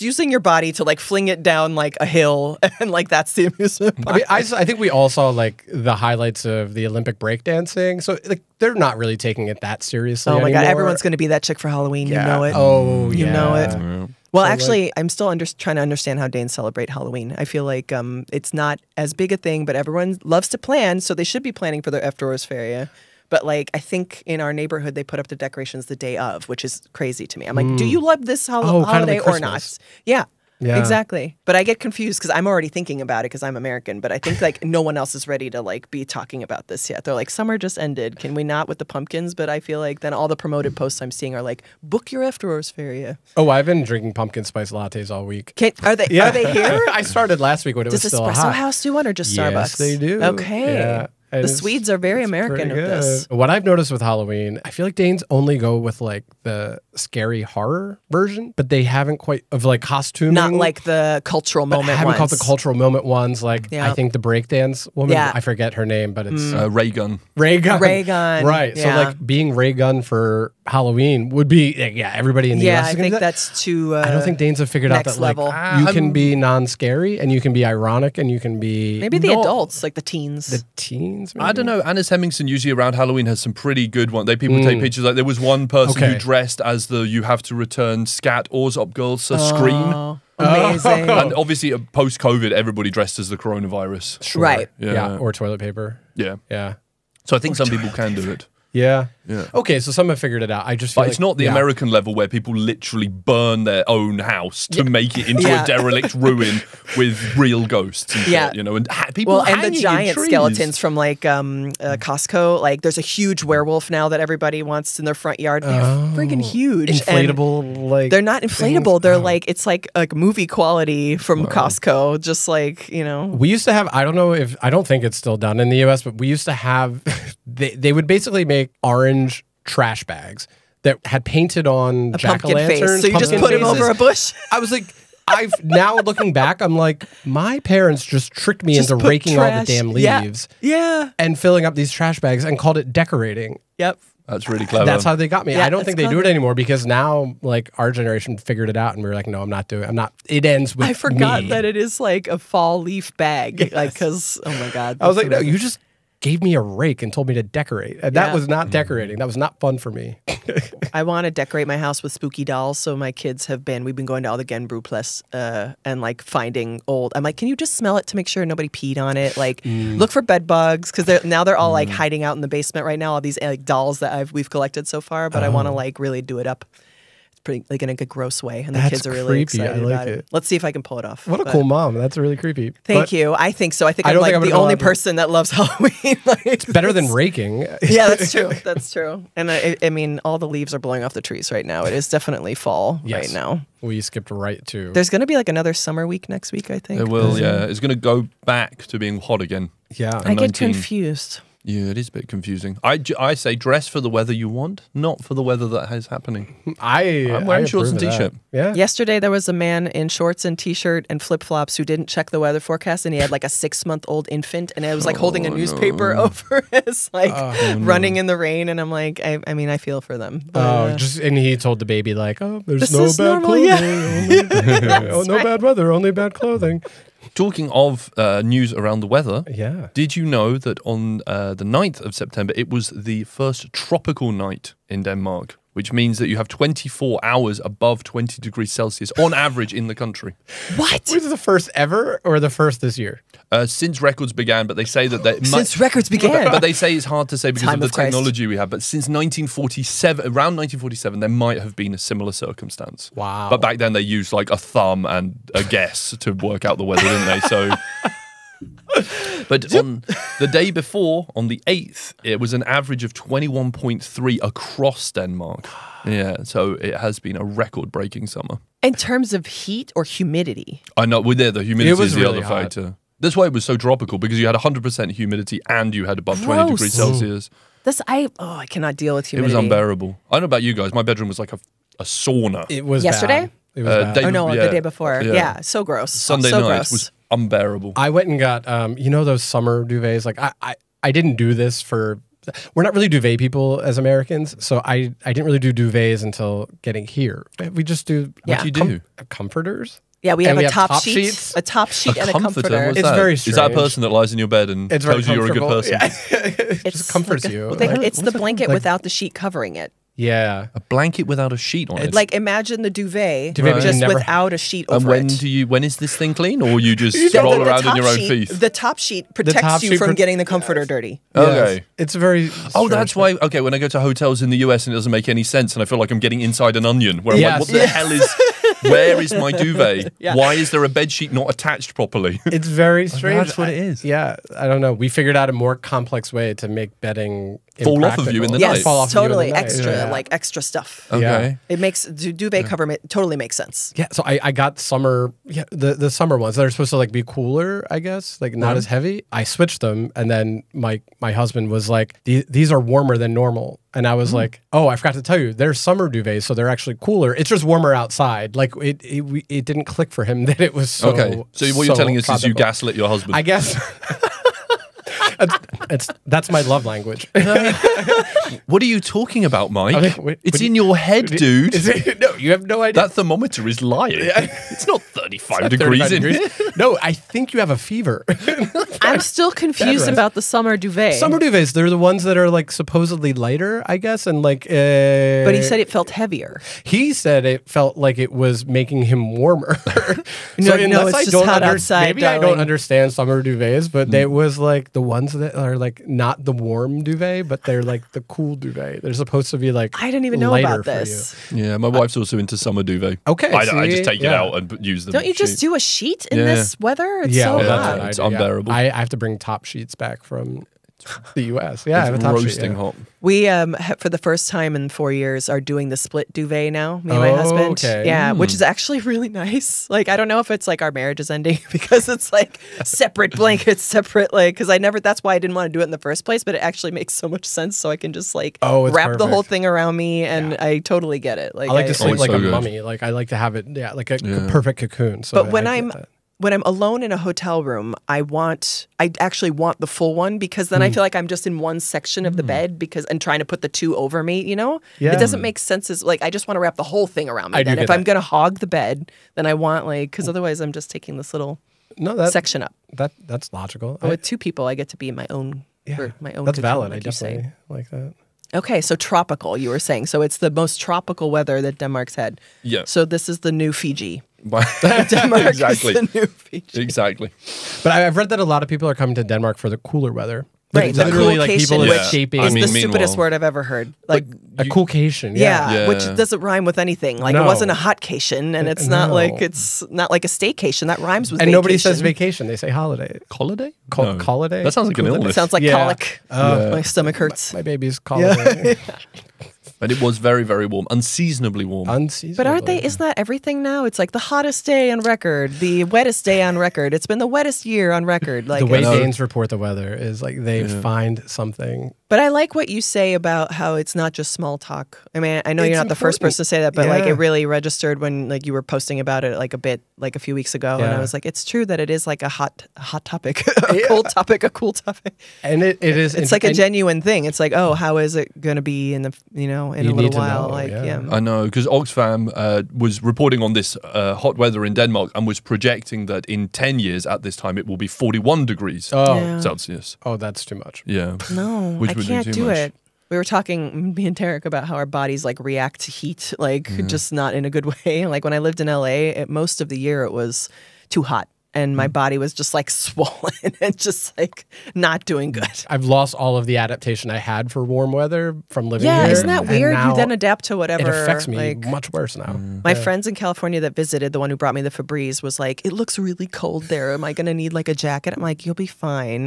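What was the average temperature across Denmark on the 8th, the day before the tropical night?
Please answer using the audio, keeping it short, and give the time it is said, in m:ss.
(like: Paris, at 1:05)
21.3 degrees, at 4:23.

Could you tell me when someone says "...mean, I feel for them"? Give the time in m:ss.
3:39.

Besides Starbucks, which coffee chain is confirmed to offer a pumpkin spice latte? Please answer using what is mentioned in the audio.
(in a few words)
Espresso House.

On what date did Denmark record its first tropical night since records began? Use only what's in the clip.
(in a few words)
9th of September.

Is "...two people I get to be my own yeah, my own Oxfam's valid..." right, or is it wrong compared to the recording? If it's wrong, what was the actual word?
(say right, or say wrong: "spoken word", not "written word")
wrong: "That", not "Oxfam".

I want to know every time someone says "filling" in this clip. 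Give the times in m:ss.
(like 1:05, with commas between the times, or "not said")
2:21.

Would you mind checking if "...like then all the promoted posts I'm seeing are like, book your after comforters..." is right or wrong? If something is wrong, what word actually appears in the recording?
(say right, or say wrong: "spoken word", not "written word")
wrong: "hours", not "comforters".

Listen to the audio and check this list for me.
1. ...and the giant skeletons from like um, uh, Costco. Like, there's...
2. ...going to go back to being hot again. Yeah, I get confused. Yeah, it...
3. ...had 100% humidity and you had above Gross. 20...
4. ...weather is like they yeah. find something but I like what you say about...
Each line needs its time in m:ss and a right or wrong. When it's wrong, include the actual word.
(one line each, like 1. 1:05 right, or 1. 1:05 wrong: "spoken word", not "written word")
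1. 1:49 right
2. 3:17 right
3. 4:34 right
4. 8:19 right.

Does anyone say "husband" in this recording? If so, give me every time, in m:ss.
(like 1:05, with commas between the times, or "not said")
5:51, 6:03, 6:57.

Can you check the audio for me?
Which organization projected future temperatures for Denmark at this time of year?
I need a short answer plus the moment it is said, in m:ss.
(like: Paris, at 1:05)
Oxfam, at 8:41.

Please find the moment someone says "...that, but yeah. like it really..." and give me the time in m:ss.
8:26.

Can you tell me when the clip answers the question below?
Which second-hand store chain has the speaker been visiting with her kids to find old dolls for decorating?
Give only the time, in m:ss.
2:44.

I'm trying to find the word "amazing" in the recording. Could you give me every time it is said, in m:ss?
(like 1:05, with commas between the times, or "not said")
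1:30, 2:35.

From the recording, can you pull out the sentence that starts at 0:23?
But like, I think in our neighborhood they put up the decorations the day of, which is crazy to me.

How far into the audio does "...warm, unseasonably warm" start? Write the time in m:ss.
8:10.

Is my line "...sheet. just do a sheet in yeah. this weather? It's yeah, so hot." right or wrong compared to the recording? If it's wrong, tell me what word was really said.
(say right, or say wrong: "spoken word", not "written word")
right.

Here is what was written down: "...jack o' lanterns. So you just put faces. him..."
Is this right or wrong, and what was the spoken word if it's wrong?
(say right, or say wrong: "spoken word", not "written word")
right.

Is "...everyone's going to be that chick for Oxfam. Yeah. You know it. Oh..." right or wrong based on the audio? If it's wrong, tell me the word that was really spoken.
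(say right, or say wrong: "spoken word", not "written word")
wrong: "Halloween", not "Oxfam".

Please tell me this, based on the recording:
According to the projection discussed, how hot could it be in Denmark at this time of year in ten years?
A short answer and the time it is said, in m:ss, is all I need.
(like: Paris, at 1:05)
41 degrees Celsius, at 8:47.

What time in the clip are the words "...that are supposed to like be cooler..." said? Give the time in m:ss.
5:46.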